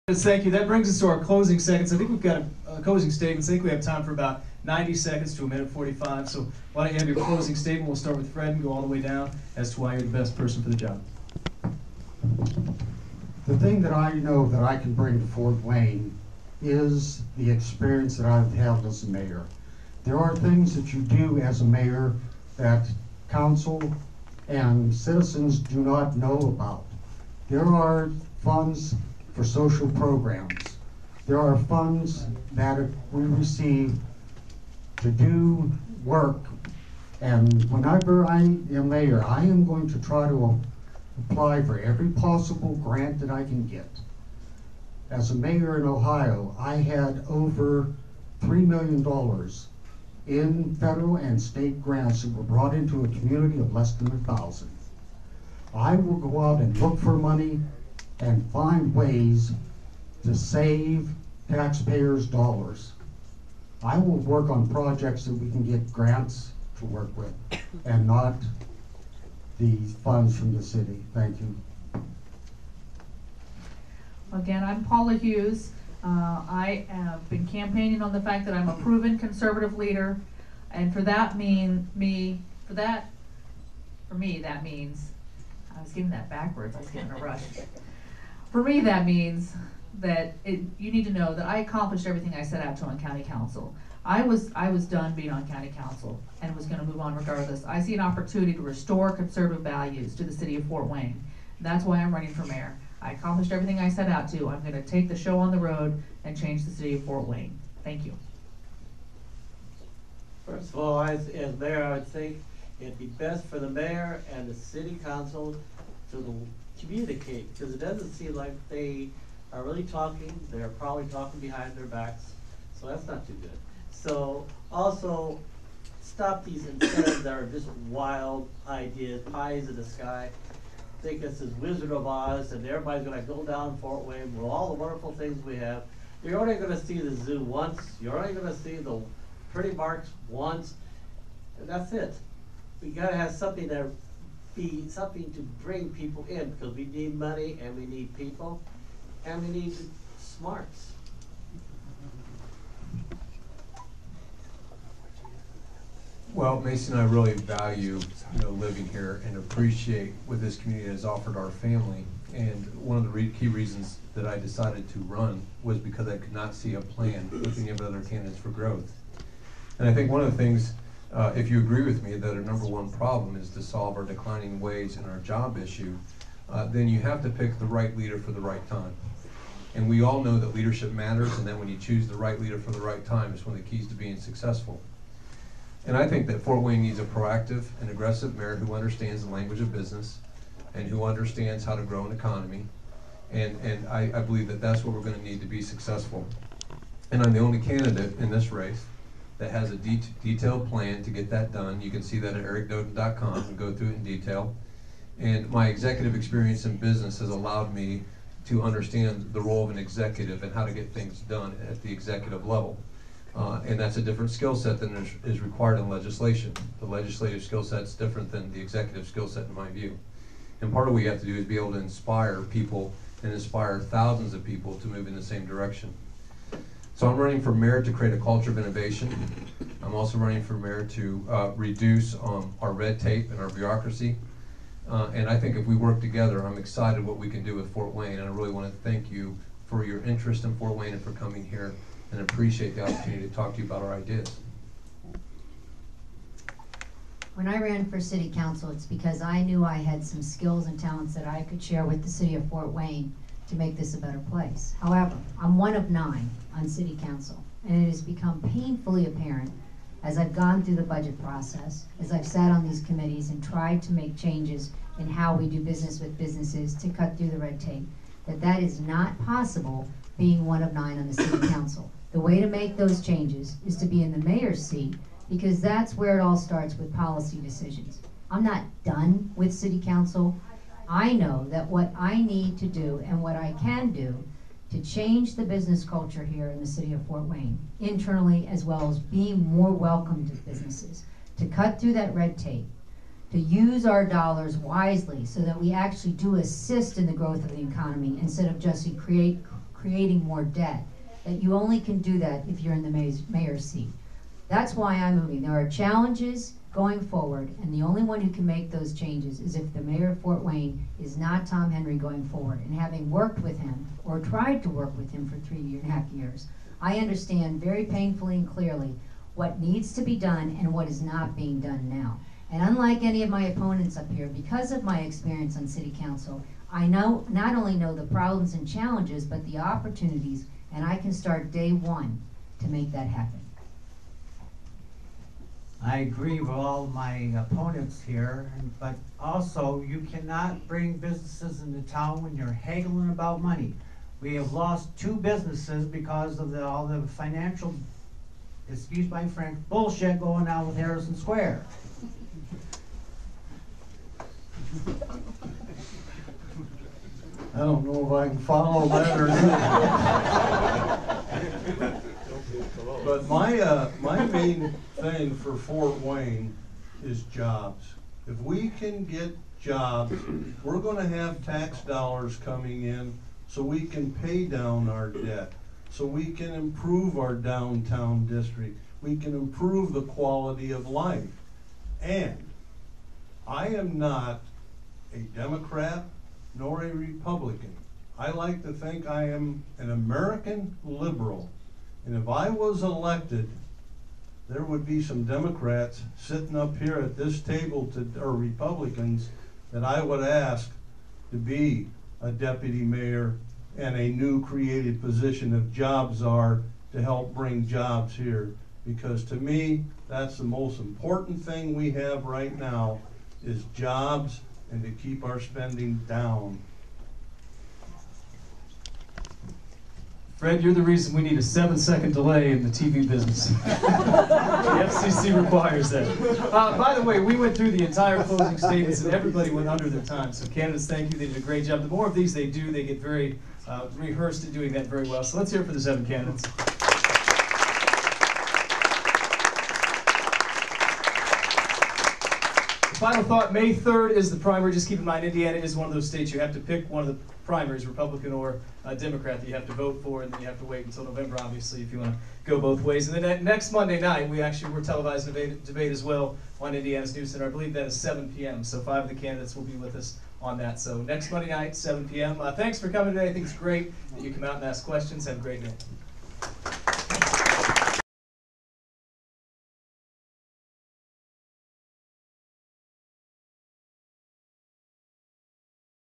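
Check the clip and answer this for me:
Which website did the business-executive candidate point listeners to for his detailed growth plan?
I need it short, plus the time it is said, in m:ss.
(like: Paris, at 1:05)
ericdoden.com, at 3:22.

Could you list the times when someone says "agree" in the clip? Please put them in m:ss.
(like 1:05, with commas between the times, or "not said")
2:51, 5:35.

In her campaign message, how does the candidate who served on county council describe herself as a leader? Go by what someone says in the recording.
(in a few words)
proven conservative leader.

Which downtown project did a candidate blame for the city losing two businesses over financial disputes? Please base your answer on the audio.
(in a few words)
Harrison Square.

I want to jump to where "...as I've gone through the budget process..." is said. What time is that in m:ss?
4:20.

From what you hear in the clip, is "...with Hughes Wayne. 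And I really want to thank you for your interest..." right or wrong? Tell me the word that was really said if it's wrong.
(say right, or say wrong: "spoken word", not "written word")
wrong: "Fort", not "Hughes".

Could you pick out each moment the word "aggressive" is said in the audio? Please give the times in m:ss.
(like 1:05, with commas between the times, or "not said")
3:07.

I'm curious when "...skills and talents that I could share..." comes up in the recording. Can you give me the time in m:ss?
4:10.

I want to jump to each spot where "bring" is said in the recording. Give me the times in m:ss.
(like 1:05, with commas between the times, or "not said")
0:00, 0:14, 2:25, 5:40, 6:47.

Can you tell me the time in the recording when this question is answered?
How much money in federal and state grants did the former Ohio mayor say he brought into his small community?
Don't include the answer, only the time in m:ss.
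0:48.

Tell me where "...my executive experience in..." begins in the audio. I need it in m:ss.
3:25.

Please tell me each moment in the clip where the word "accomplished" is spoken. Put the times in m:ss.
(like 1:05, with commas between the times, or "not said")
1:31, 1:43.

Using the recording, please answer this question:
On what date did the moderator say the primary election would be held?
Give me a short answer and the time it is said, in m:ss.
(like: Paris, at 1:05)
May 3, at 7:23.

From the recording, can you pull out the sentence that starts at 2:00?
They're probably talking behind their backs, so that's not too good.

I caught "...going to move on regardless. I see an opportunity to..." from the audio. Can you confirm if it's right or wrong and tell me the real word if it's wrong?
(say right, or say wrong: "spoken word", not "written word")
right.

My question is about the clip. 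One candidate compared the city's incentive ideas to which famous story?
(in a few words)
Wizard of Oz.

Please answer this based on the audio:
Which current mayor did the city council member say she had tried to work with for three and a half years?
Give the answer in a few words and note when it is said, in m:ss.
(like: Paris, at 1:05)
Tom Henry, at 5:11.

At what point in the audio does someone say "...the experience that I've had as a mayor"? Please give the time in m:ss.
0:17.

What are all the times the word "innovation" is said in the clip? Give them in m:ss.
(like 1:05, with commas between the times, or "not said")
3:48.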